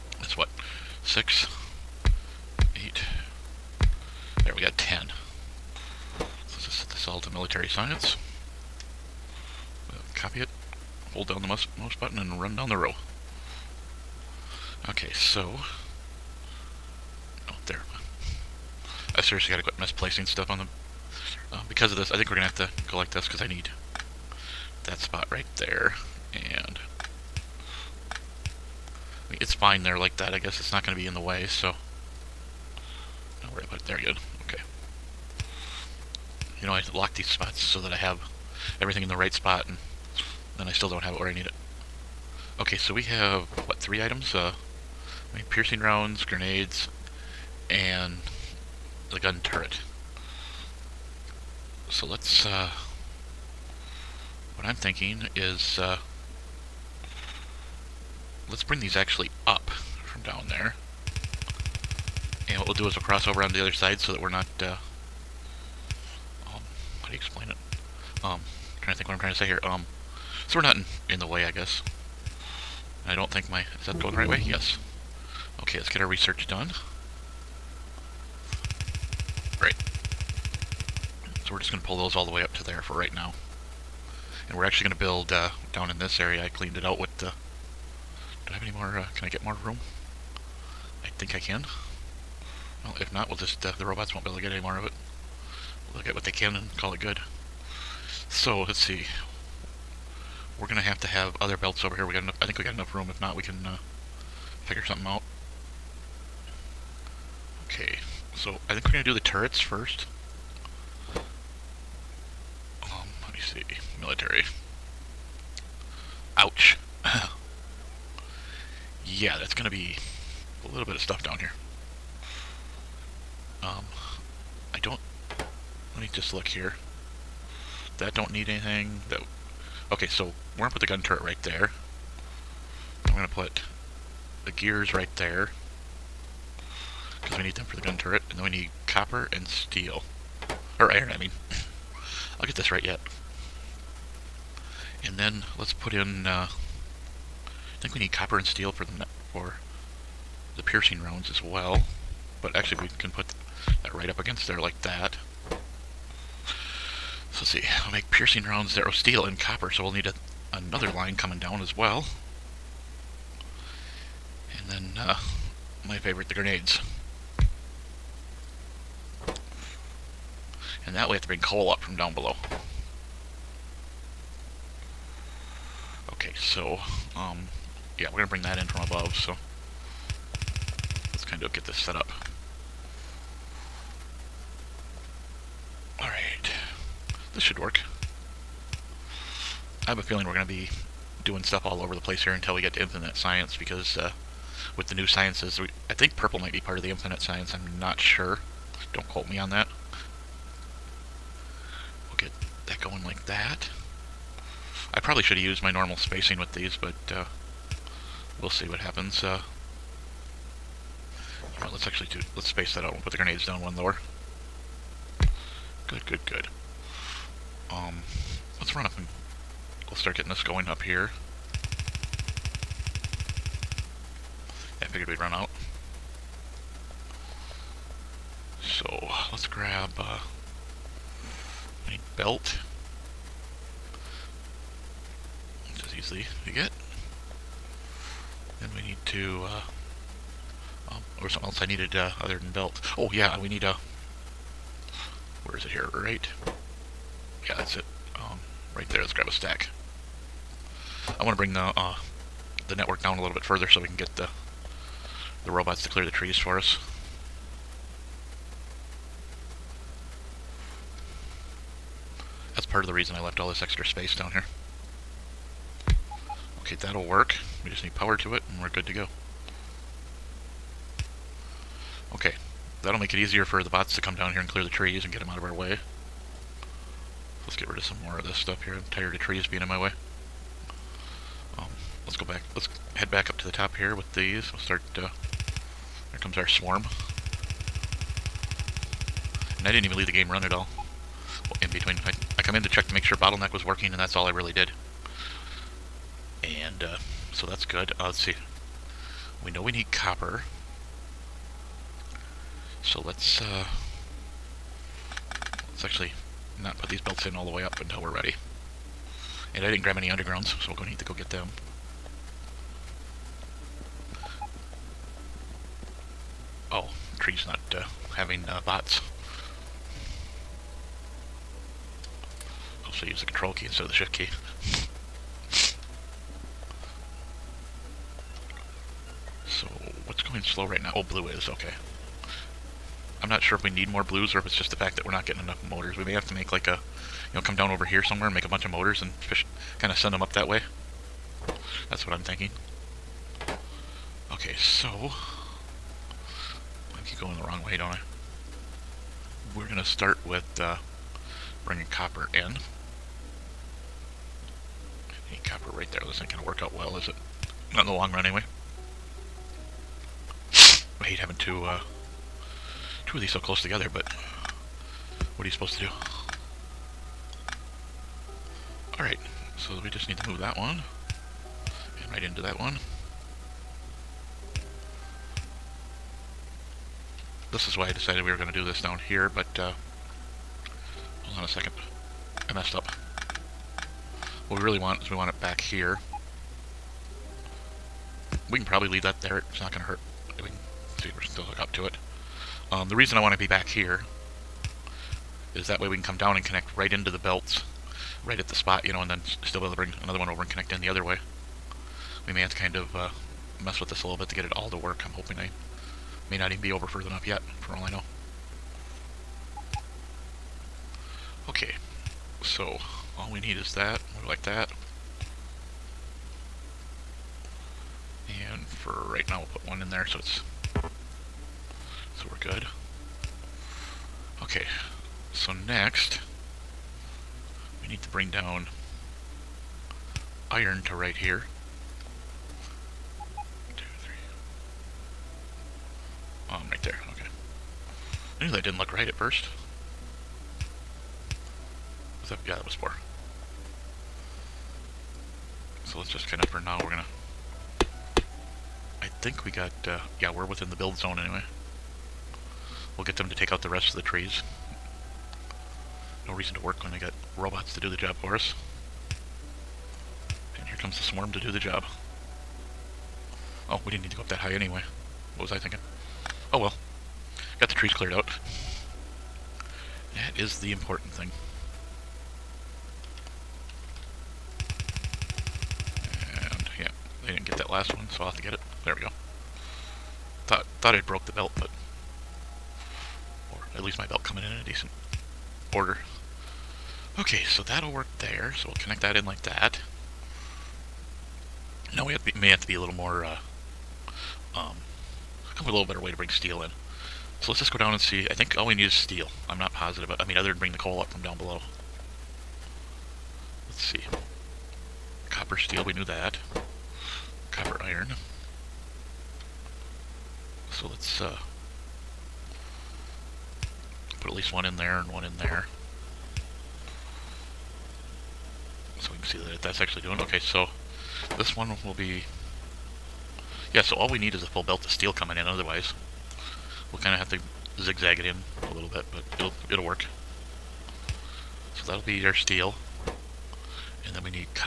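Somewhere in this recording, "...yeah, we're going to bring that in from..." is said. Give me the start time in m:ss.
2:57.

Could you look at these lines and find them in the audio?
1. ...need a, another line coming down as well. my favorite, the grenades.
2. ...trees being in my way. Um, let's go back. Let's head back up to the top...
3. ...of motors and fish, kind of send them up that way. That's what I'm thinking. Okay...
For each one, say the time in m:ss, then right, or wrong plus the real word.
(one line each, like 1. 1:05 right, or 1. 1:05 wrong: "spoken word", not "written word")
1. 2:39 right
2. 4:39 right
3. 5:38 right.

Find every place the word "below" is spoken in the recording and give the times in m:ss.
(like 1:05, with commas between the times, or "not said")
2:52, 8:21.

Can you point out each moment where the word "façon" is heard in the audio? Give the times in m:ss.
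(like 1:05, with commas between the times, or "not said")
not said.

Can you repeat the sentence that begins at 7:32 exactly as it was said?
We'll get them to take out the rest of the trees.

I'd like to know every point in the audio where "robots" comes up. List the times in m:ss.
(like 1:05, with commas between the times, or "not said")
1:33, 4:15, 7:37.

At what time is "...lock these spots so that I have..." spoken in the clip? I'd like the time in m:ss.
0:36.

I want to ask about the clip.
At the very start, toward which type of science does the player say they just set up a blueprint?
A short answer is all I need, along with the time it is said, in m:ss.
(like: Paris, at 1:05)
Military science, at 0:07.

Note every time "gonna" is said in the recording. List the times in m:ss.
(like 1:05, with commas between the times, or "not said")
0:22, 5:49, 5:56, 7:26.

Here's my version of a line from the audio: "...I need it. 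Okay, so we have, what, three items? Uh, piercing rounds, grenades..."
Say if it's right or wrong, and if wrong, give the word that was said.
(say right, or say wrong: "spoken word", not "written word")
right.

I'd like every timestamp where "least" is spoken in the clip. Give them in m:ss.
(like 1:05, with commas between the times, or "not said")
8:03, 8:34.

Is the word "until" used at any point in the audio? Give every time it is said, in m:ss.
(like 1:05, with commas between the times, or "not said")
3:12, 5:07.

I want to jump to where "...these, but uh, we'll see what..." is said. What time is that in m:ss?
3:26.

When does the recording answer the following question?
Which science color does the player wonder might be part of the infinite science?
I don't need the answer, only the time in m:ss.
3:16.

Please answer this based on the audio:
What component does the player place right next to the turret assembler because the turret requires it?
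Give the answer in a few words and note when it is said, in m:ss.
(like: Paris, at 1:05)
Gears, at 2:14.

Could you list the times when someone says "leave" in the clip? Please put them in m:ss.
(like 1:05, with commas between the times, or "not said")
4:49, 6:28.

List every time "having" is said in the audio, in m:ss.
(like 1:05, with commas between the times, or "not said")
5:18, 6:01.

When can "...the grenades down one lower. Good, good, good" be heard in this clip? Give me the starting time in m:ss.
3:33.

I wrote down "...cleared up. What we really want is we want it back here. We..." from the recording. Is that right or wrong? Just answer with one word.
wrong.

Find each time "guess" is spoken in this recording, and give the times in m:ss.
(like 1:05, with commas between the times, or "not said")
0:30, 1:11.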